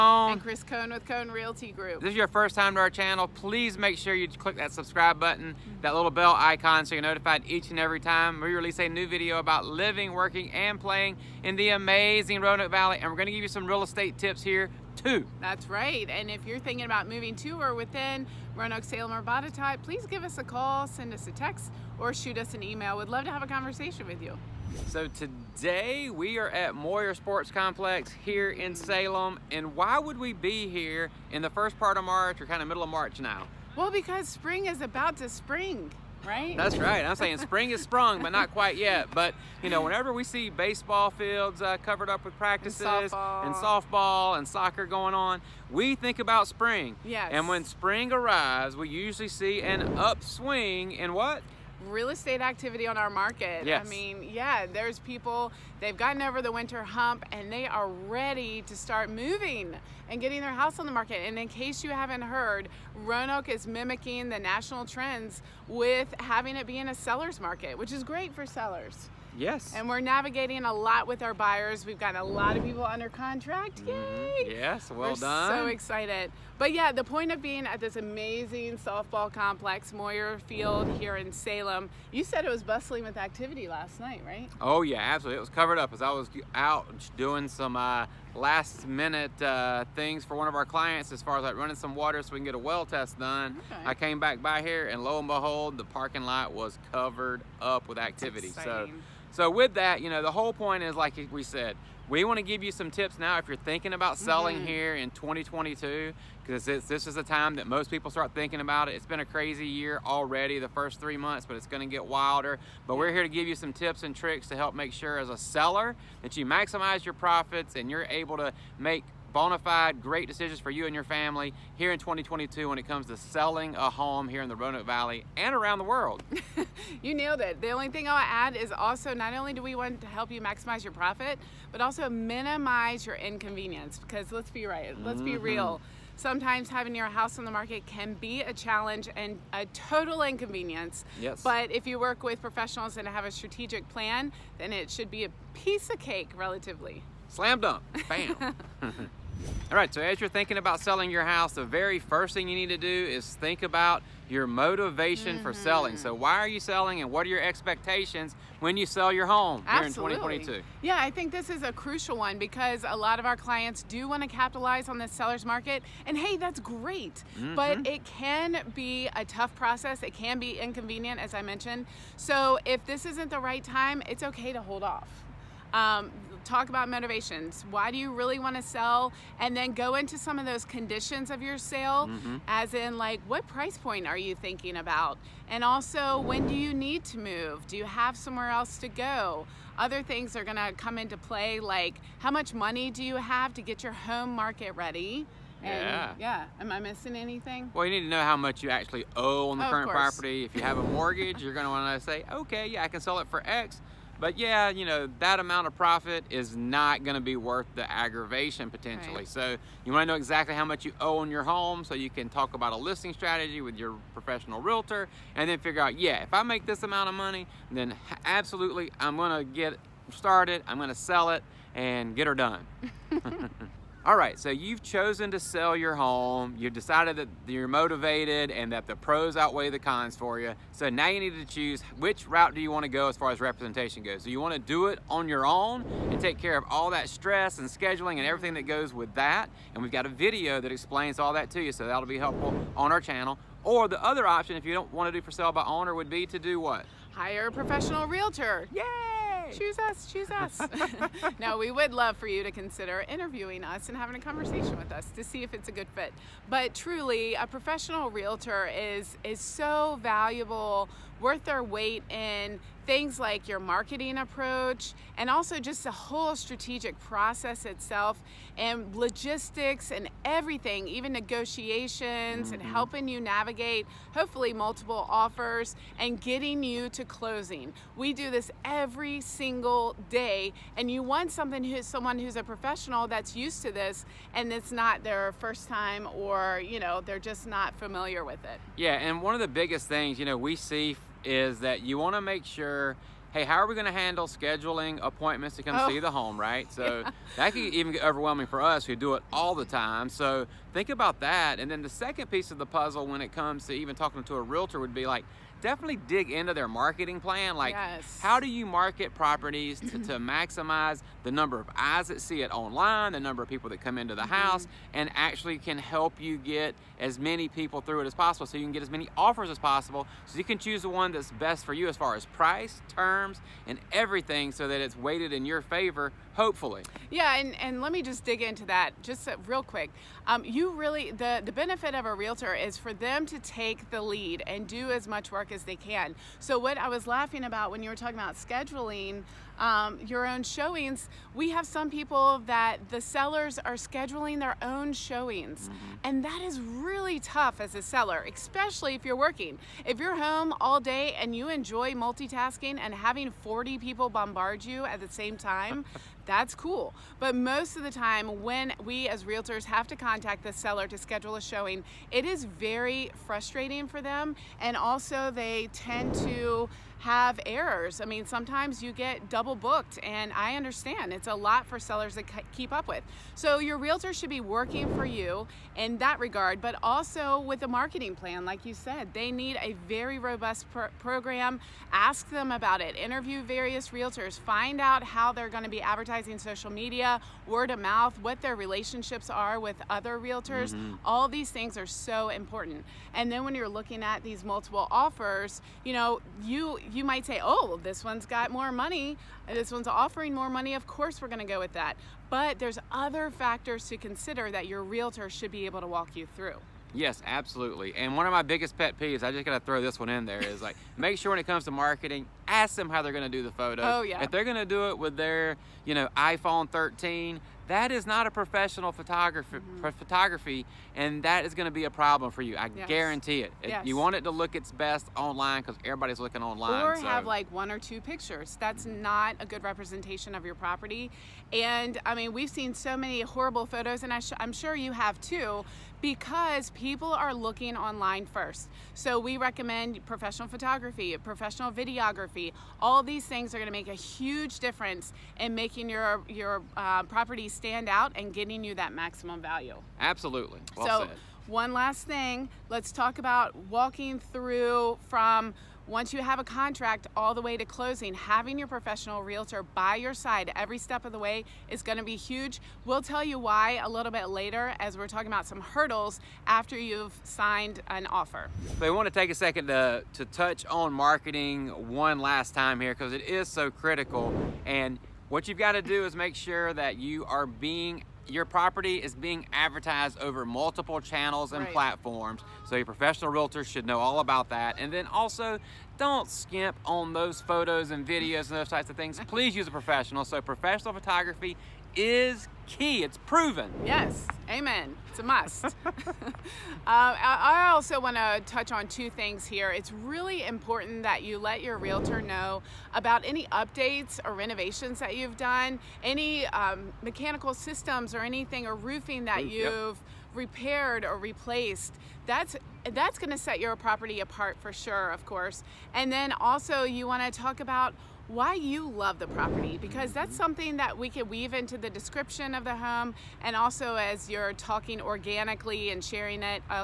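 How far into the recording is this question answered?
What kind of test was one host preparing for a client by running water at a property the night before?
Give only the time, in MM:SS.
01:32.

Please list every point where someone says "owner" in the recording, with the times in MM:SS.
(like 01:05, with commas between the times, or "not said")
04:05.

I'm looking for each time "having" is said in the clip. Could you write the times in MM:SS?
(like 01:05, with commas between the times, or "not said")
01:06, 02:16, 04:13, 05:53, 07:38.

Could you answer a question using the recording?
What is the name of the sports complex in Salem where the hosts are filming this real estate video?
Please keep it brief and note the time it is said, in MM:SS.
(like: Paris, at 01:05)
Moyer Sports Complex, at 00:26.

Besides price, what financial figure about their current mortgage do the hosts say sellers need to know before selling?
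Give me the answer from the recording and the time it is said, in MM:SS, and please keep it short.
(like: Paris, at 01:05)
how much you owe, at 03:18.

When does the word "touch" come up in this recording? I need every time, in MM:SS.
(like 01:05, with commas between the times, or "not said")
07:50, 08:18.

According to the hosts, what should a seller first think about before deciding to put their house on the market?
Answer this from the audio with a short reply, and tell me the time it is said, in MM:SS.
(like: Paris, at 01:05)
motivation, at 02:34.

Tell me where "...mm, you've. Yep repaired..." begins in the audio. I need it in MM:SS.
08:29.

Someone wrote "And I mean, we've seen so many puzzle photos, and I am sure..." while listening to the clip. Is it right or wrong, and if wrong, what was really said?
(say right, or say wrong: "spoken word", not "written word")
wrong: "horrible", not "puzzle".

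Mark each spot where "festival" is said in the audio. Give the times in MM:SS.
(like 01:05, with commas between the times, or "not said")
not said.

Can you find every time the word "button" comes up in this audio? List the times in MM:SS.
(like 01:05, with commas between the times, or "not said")
00:05.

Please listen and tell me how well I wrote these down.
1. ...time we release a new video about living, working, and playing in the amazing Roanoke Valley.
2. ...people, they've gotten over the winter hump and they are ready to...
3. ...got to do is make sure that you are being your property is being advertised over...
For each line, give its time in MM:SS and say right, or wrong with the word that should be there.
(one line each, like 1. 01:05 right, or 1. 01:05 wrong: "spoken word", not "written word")
1. 00:07 right
2. 00:54 right
3. 07:55 right.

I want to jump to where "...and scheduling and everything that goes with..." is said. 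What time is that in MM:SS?
03:57.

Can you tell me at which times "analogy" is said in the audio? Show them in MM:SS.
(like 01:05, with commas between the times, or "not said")
not said.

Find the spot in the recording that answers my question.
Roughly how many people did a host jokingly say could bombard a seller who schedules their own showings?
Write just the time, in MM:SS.
05:53.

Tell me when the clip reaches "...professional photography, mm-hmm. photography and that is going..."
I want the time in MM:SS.
06:58.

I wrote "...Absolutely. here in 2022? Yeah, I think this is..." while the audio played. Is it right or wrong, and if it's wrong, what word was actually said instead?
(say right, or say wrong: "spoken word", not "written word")
right.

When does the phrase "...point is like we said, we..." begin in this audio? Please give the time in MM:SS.
01:40.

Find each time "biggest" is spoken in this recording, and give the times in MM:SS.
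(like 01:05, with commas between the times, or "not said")
04:49, 06:48.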